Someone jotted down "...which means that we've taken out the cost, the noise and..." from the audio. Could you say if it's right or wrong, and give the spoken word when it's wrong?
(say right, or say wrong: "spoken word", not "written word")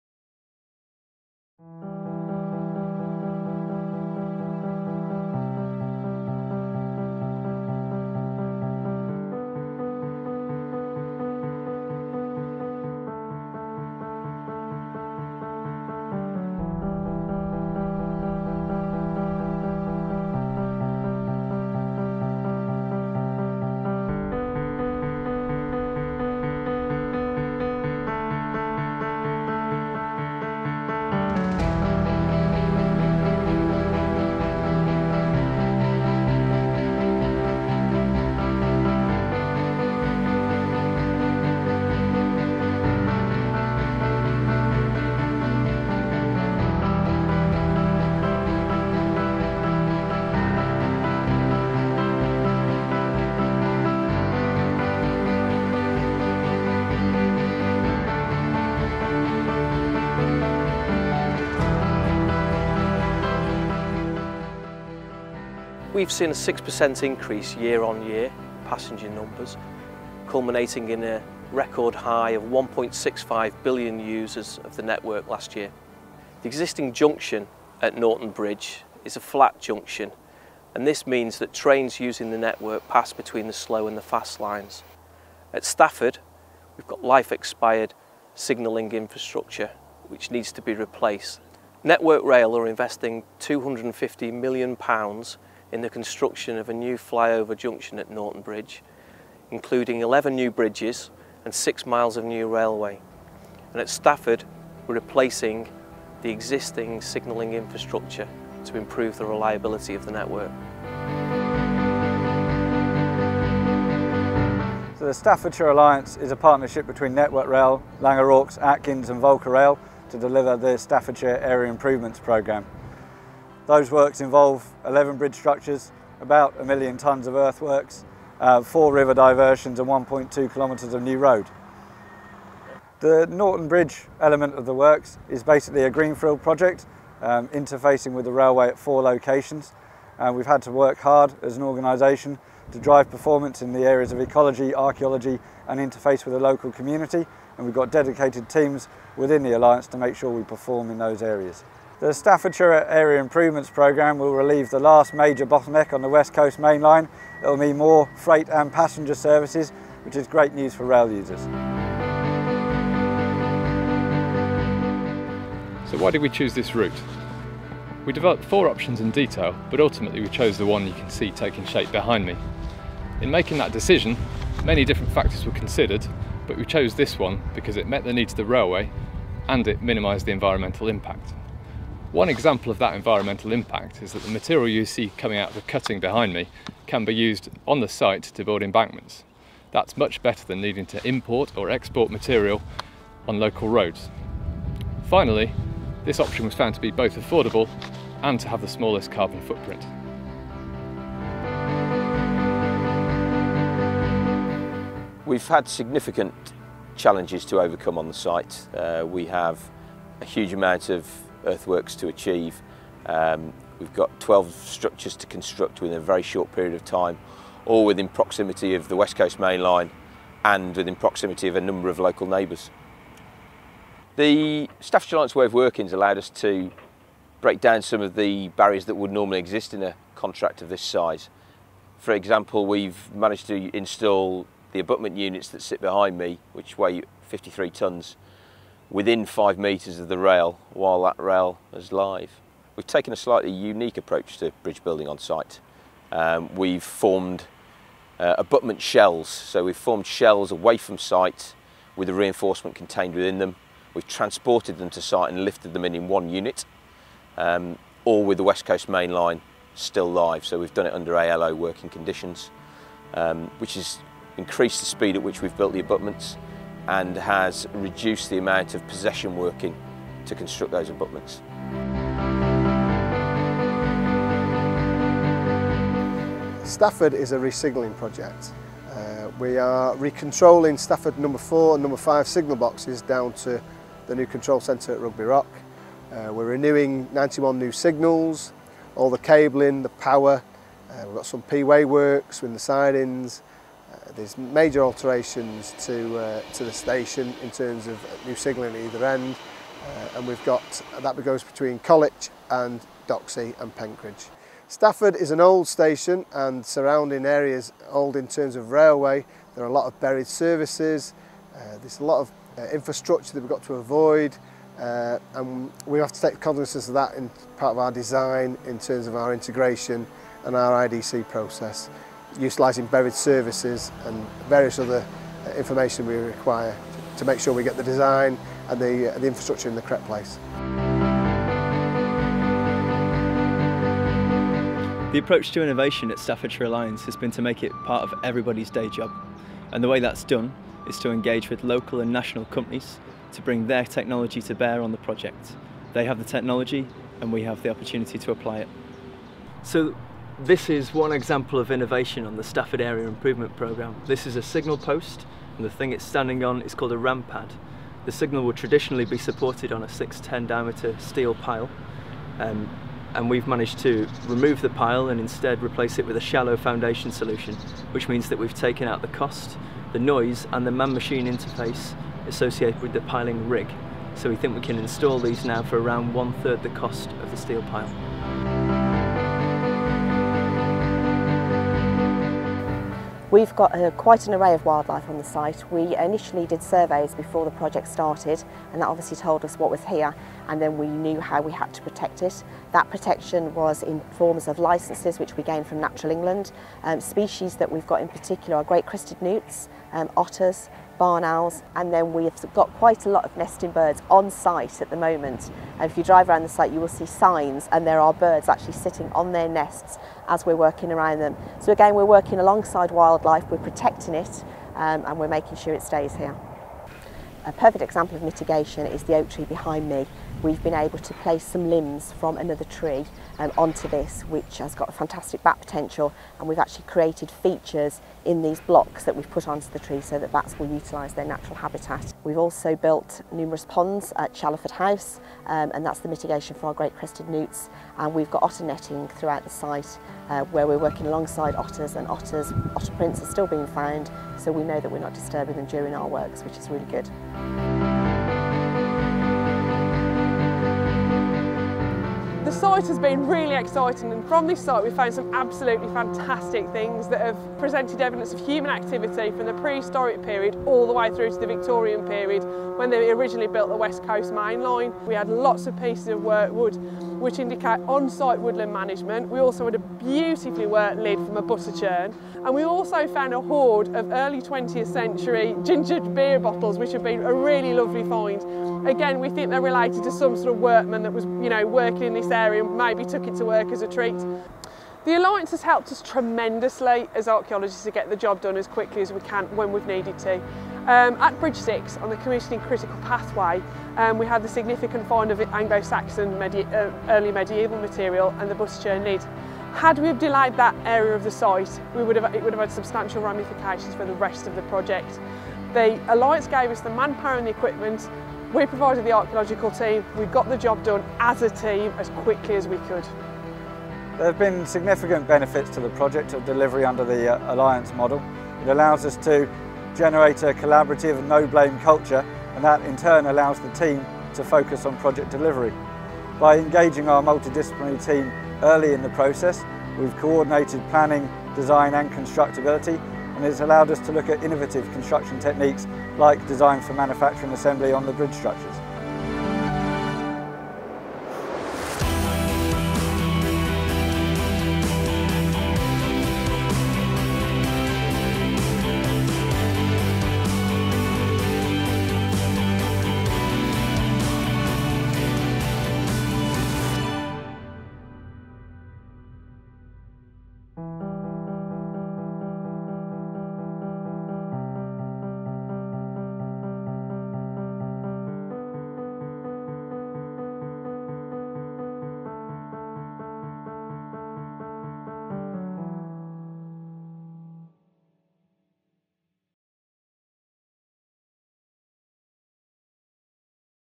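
right.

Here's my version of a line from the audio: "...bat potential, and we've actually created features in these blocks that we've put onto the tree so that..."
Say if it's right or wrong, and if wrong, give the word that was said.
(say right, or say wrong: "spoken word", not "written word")
right.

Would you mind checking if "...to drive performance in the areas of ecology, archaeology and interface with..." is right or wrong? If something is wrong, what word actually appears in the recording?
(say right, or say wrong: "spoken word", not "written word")
right.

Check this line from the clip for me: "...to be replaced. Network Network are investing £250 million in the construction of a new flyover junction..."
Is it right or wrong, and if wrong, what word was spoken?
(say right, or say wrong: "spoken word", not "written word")
wrong: "Rail", not "Network".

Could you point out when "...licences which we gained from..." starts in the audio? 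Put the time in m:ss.
6:34.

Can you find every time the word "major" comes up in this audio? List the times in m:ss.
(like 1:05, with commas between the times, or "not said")
2:35, 4:54.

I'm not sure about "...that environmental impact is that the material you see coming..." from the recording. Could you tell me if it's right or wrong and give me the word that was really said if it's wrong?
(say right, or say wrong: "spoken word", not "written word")
right.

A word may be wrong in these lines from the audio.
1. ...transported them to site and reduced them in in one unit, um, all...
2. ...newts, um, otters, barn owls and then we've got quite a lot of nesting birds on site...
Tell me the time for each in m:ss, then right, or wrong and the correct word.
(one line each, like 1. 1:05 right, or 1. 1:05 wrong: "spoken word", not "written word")
1. 4:14 wrong: "lifted", not "reduced"
2. 6:39 right.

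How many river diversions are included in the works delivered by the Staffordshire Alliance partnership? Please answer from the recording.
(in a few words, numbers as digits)
4.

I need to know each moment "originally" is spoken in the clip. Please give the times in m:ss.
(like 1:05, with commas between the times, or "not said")
7:43.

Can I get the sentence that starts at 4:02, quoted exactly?
We've taken a slightly unique approach to bridge building on site.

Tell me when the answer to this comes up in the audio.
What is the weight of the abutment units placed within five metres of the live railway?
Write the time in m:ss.
3:57.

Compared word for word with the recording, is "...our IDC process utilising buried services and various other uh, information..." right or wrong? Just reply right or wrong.
right.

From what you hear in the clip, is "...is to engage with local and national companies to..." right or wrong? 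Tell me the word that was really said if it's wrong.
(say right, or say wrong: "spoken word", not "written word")
right.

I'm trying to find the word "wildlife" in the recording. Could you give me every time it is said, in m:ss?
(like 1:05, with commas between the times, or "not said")
6:24, 6:52.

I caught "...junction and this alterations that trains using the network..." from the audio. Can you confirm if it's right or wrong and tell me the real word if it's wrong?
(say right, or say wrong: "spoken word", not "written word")
wrong: "means", not "alterations".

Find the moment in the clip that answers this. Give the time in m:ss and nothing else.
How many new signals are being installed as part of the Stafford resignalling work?
4:47.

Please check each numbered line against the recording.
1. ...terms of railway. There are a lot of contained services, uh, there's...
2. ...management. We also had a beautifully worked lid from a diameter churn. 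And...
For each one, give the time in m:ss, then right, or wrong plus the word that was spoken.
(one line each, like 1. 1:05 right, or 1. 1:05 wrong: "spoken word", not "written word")
1. 5:08 wrong: "buried", not "contained"
2. 7:48 wrong: "butter", not "diameter".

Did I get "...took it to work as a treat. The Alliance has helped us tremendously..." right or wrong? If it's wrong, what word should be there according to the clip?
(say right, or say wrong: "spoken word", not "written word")
right.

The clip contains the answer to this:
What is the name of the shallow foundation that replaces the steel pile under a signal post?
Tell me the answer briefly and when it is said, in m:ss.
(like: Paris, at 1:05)
ramp pad, at 5:56.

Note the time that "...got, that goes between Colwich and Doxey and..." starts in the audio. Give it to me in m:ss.
5:00.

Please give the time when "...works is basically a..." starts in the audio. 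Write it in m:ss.
2:14.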